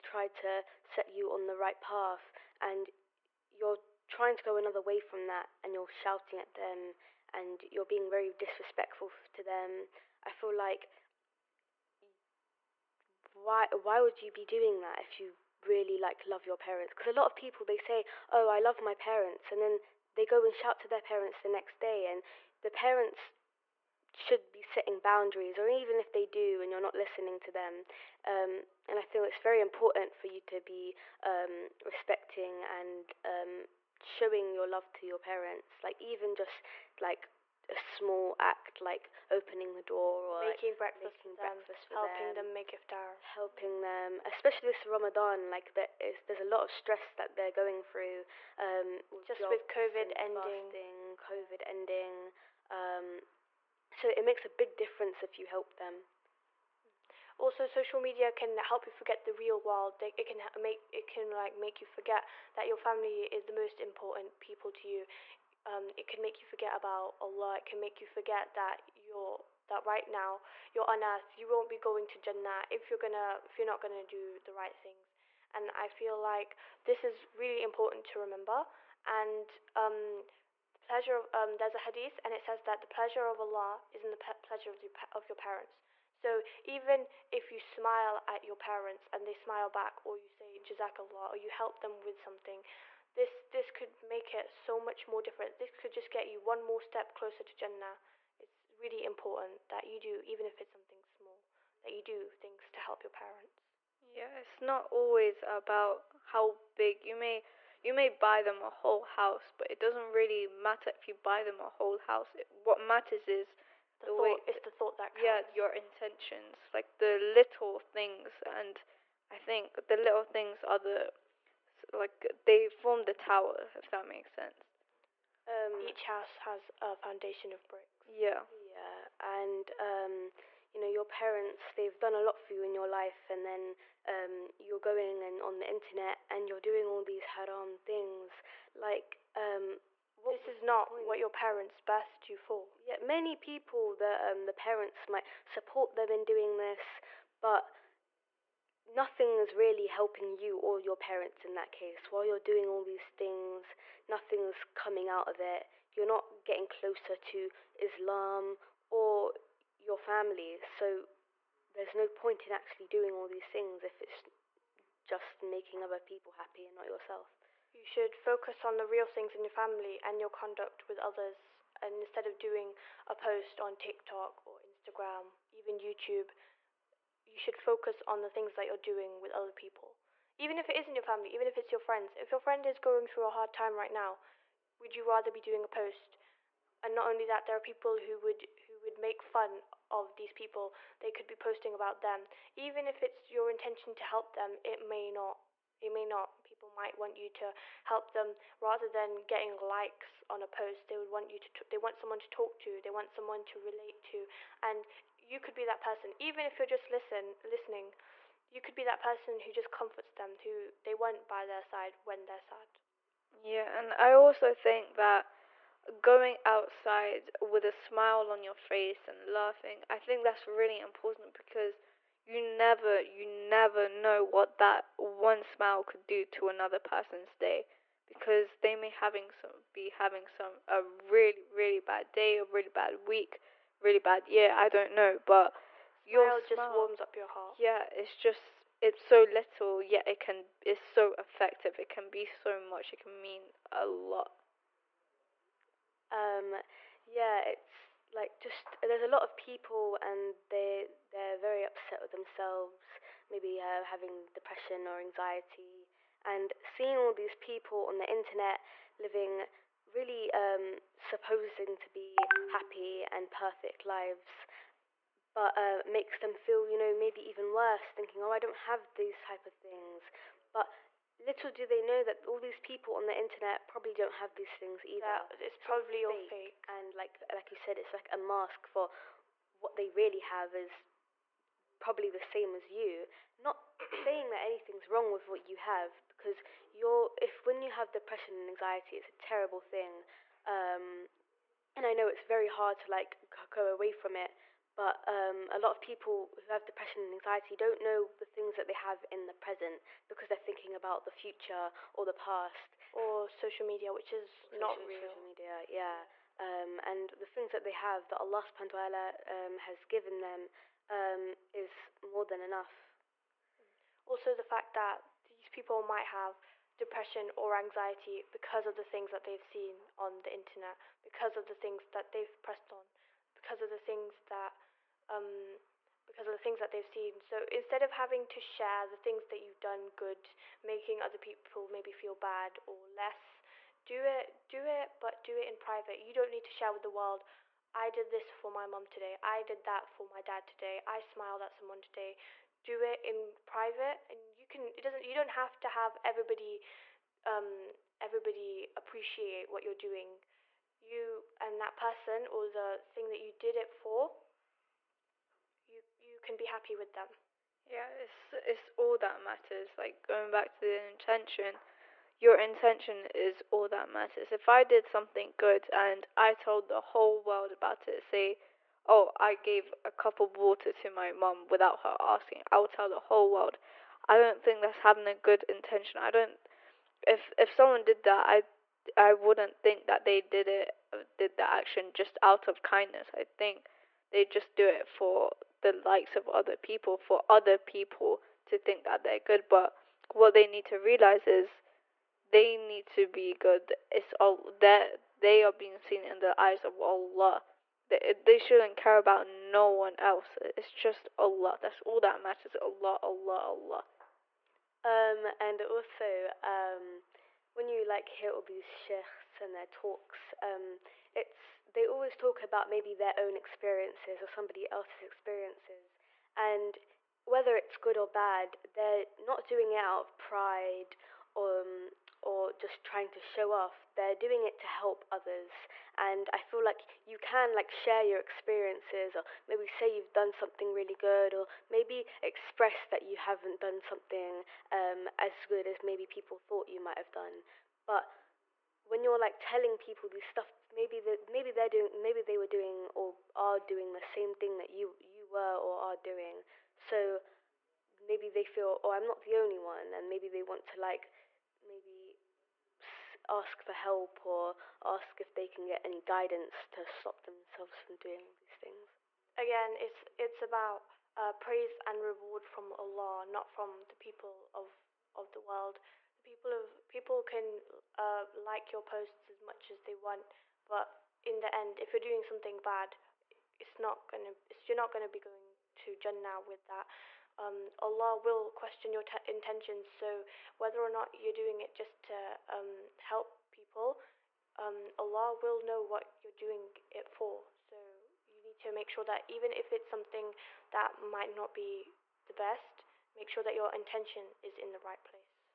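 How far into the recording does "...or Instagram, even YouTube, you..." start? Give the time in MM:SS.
02:54.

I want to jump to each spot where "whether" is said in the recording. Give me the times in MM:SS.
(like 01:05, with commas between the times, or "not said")
06:57, 08:00.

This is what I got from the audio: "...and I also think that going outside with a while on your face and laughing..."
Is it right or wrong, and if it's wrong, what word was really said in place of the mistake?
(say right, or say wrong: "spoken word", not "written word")
wrong: "smile", not "while".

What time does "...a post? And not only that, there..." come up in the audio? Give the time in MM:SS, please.
03:05.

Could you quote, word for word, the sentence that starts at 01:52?
It, what matters is the, the thought.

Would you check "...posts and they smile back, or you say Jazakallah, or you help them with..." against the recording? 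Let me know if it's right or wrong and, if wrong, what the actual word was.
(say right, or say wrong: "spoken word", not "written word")
wrong: "parents", not "posts".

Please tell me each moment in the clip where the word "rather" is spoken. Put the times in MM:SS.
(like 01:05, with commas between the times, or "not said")
03:05, 03:18.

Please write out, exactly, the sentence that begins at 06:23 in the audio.
I think they just do it for the likes of other people, for other people to think that they're good.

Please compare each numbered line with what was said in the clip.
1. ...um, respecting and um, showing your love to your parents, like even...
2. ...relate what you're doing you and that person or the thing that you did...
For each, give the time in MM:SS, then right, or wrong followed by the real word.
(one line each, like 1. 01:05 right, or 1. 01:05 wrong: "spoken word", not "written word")
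1. 00:31 right
2. 05:48 wrong: "appreciate", not "relate".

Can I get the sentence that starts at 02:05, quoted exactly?
Um, Each house has a foundation of bricks.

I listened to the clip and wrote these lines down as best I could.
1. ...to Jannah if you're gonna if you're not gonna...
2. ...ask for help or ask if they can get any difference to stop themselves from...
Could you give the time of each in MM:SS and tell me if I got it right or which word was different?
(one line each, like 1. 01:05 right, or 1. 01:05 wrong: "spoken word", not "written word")
1. 01:12 right
2. 07:33 wrong: "guidance", not "difference".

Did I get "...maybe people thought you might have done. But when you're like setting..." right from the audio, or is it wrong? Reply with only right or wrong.
wrong.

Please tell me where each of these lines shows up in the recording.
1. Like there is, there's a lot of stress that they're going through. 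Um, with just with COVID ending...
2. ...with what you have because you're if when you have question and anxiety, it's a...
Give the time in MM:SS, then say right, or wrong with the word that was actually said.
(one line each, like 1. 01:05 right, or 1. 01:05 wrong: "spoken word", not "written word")
1. 00:45 right
2. 04:45 wrong: "depression", not "question".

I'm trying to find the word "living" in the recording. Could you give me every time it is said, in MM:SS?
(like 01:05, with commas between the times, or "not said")
04:18.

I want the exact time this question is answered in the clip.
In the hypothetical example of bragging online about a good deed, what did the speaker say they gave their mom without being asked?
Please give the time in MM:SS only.
06:09.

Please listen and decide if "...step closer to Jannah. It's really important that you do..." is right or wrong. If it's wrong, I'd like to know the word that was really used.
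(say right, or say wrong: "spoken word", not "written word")
right.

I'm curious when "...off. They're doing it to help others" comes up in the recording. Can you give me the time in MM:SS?
07:03.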